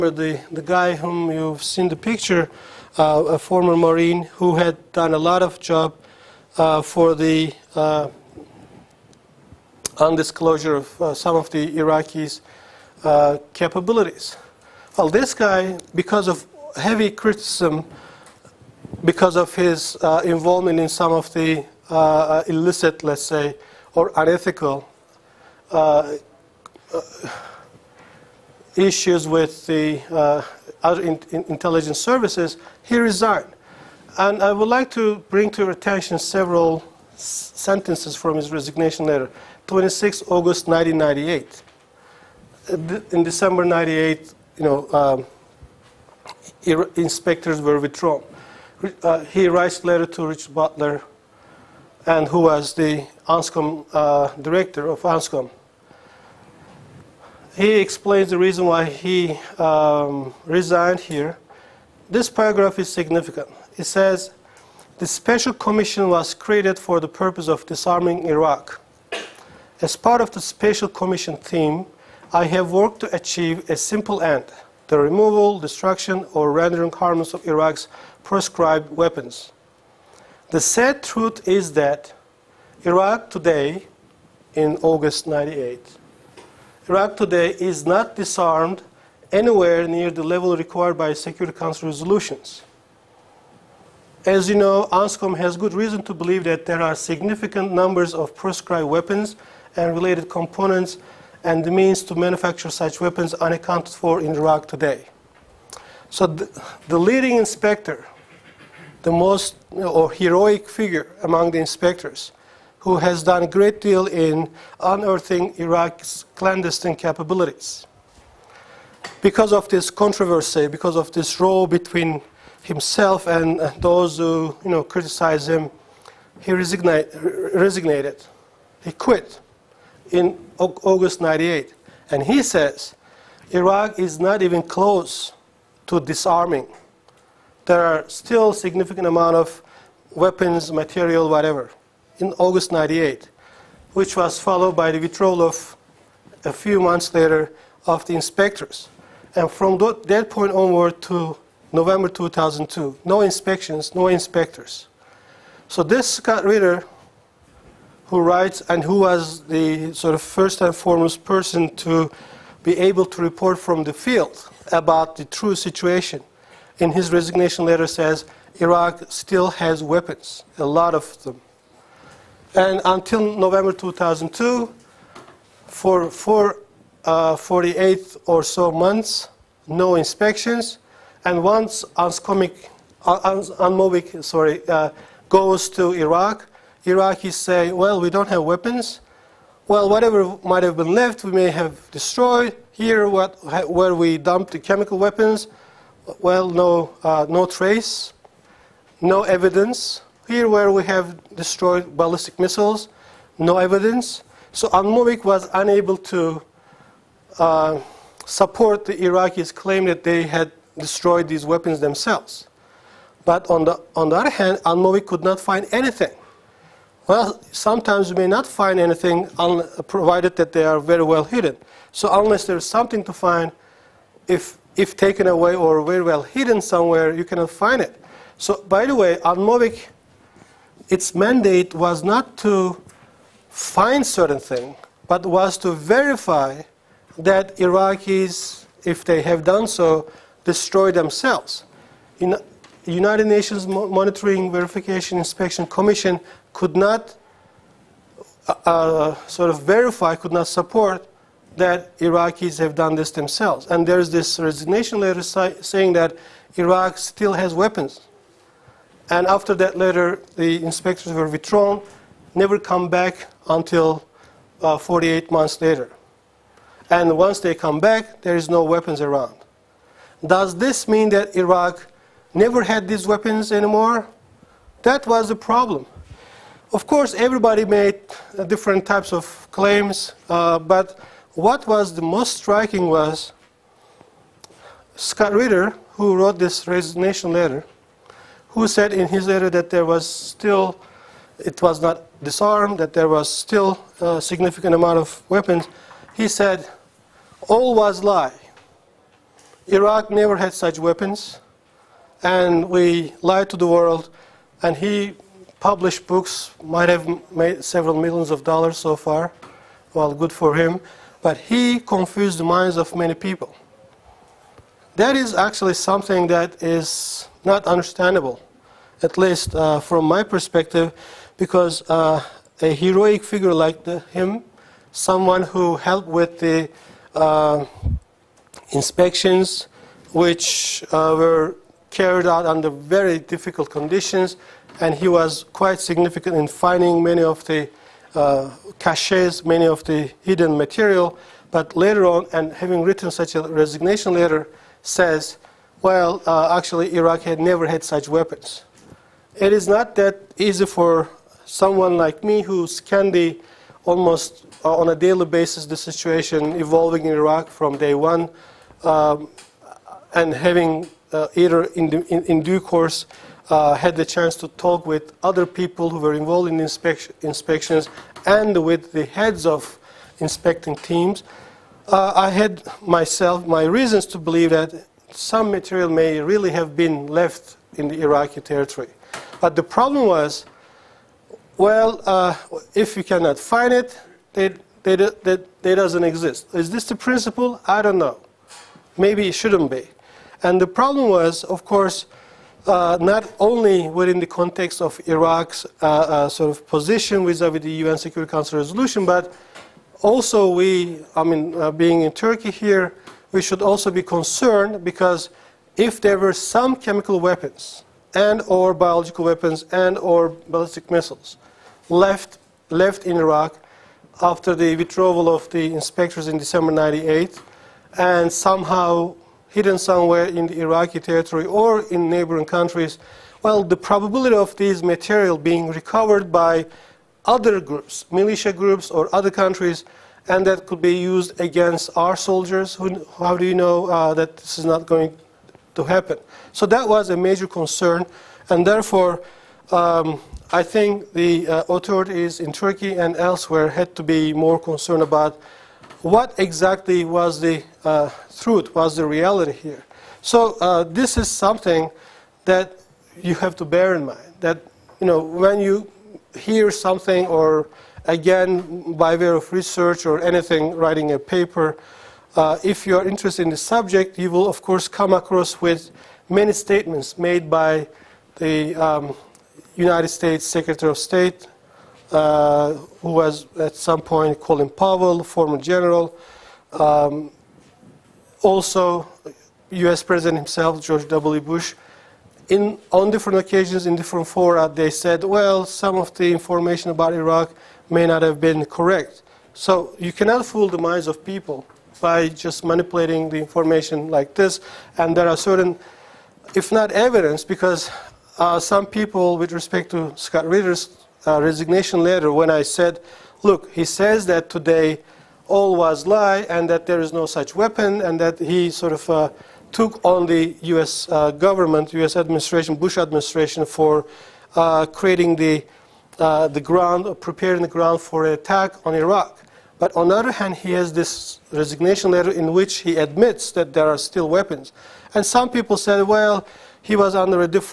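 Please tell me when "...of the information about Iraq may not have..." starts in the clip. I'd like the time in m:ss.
8:05.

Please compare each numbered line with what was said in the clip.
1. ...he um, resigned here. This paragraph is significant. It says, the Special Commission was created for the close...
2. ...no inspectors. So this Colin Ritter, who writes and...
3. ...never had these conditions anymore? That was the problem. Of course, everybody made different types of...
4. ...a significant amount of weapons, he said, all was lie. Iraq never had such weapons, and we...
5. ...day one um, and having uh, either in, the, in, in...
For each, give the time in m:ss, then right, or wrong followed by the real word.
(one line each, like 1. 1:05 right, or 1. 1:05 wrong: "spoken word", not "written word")
1. 0:58 wrong: "purpose", not "close"
2. 2:33 wrong: "Scott", not "Colin"
3. 4:32 wrong: "weapons", not "conditions"
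4. 4:54 right
5. 5:57 right.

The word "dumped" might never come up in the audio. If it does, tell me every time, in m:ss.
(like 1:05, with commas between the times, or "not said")
3:14.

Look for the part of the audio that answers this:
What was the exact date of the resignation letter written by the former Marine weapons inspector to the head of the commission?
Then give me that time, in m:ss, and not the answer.
0:39.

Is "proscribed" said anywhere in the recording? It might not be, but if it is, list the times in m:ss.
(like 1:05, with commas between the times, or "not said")
1:18, 1:38.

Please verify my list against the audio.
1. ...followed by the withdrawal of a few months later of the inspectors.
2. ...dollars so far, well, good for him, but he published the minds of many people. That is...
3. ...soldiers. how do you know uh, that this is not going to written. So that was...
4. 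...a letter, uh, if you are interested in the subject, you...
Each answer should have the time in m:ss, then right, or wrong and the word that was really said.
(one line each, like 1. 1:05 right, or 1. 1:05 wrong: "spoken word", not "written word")
1. 2:24 right
2. 5:08 wrong: "confused", not "published"
3. 7:12 wrong: "happen", not "written"
4. 7:41 wrong: "paper", not "letter".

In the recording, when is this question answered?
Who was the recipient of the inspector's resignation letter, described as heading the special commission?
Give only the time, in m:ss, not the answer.
0:50.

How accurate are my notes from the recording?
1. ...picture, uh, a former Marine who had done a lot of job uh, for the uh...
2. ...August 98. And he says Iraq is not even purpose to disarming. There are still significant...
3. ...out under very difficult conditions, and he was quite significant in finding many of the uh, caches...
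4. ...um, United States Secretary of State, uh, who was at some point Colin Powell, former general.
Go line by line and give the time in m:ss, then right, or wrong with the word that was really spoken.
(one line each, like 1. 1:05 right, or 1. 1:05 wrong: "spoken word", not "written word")
1. 0:01 right
2. 2:10 wrong: "close", not "purpose"
3. 5:32 right
4. 7:48 right.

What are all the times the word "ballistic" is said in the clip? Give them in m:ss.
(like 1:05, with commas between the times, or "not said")
3:21, 6:50.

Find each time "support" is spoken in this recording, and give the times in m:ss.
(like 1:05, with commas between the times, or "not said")
3:28, 4:10.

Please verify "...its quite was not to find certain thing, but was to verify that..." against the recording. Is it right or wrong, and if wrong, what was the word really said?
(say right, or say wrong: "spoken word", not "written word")
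wrong: "mandate", not "quite".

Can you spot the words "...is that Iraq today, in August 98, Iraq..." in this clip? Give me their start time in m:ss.
1:21.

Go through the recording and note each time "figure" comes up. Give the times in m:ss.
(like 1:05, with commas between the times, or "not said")
1:50, 5:23.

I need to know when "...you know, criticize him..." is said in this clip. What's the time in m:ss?
2:04.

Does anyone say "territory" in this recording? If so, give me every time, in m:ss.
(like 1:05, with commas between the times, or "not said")
6:18, 7:00.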